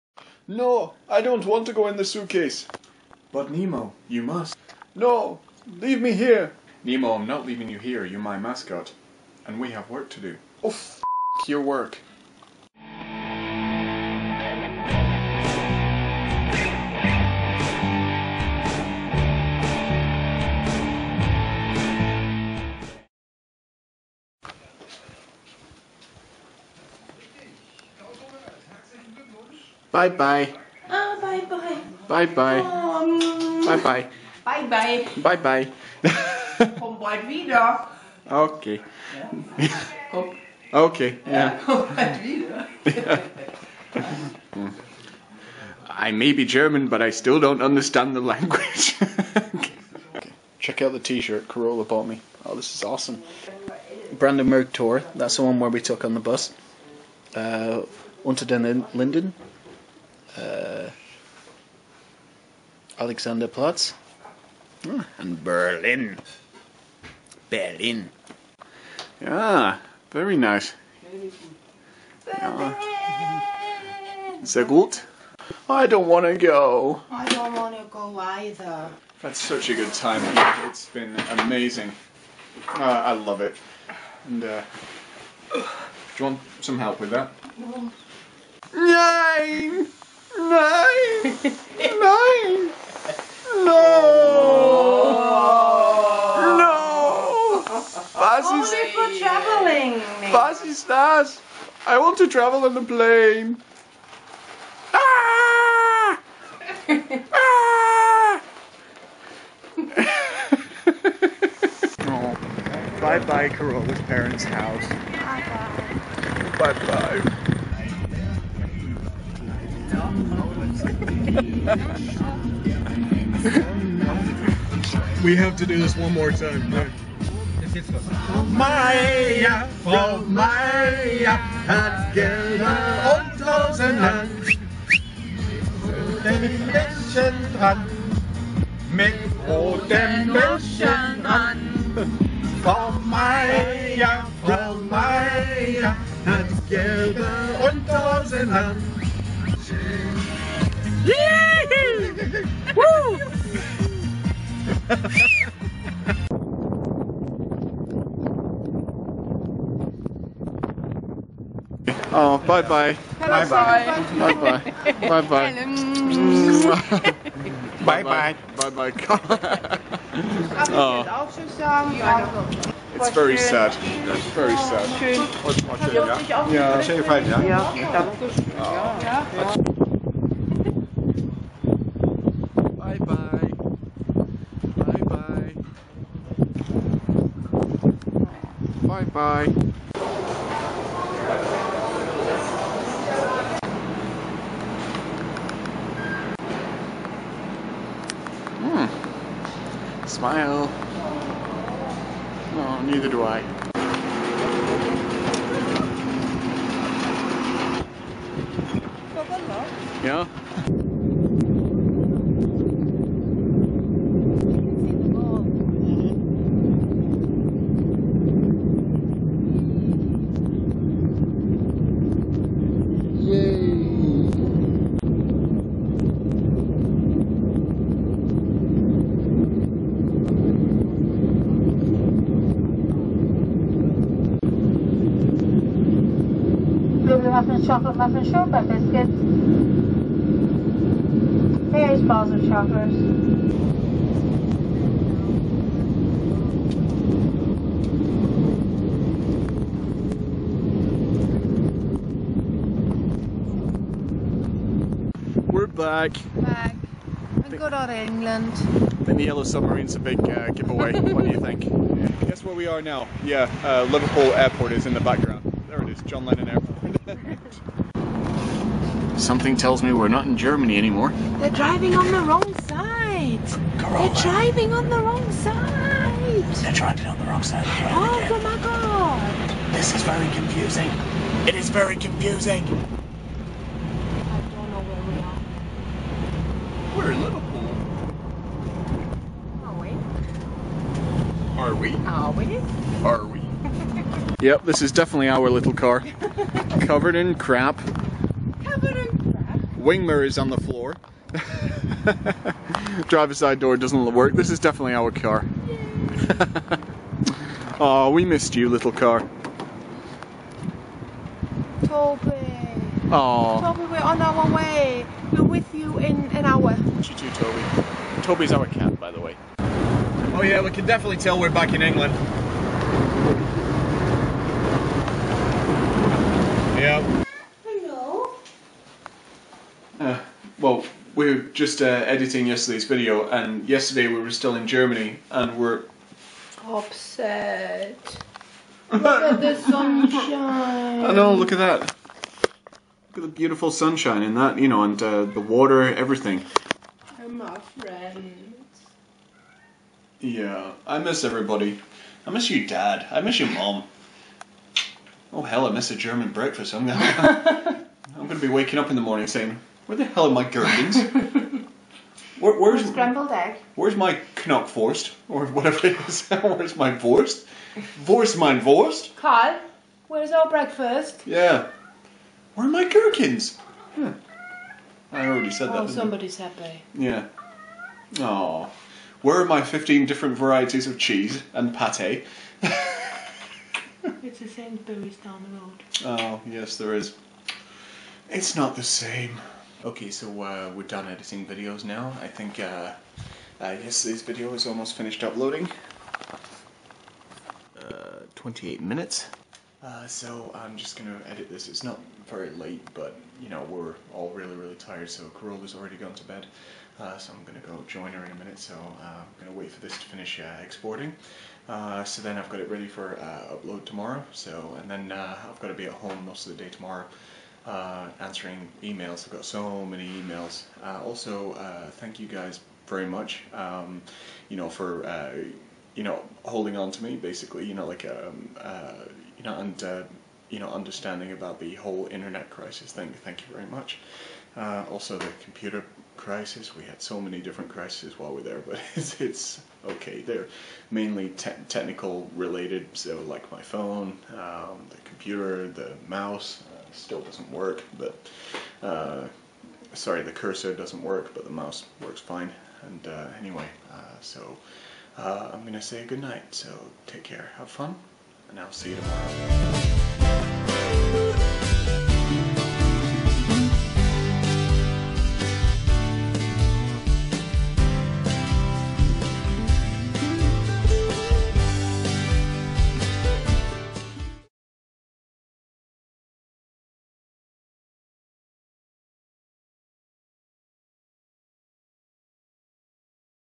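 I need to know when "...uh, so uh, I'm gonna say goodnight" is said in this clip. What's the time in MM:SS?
07:33.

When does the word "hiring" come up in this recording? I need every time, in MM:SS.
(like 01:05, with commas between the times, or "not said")
not said.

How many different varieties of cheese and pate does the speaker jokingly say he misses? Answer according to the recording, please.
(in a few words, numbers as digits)
15.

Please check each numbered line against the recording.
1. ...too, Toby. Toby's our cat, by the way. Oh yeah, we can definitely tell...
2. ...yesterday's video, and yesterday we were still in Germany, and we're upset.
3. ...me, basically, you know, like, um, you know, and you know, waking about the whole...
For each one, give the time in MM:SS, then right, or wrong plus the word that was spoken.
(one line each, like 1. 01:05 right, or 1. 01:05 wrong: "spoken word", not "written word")
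1. 05:17 right
2. 05:32 right
3. 07:07 wrong: "understanding", not "waking".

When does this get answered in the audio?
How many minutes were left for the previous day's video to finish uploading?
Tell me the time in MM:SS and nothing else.
06:38.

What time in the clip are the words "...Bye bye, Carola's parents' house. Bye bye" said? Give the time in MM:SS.
01:53.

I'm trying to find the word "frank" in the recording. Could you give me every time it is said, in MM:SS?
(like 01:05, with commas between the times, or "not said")
not said.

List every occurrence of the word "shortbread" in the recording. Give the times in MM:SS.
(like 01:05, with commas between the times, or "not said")
03:58.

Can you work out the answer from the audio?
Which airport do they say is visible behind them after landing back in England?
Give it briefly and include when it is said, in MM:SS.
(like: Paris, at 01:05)
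John Lennon Airport, at 04:26.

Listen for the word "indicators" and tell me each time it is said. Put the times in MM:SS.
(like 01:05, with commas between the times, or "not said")
not said.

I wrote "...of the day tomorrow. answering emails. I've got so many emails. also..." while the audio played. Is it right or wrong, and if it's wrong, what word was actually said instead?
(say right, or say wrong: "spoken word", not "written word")
right.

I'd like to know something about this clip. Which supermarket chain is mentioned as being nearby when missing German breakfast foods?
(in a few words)
Sainsbury's.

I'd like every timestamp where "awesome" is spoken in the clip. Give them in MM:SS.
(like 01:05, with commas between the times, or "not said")
00:52.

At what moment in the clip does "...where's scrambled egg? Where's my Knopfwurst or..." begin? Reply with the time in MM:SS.
06:02.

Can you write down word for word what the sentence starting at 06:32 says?
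I think uh, uh, yesterday's video is almost finished uploading.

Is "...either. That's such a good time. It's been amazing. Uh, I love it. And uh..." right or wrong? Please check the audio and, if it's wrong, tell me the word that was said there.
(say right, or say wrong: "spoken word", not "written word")
right.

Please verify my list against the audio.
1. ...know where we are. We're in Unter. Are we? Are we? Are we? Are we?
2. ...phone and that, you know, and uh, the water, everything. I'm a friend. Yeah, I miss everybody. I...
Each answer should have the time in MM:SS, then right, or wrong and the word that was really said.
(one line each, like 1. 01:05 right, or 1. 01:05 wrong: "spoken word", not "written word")
1. 04:44 wrong: "Liverpool", not "Unter"
2. 05:43 wrong: "sunshine", not "phone".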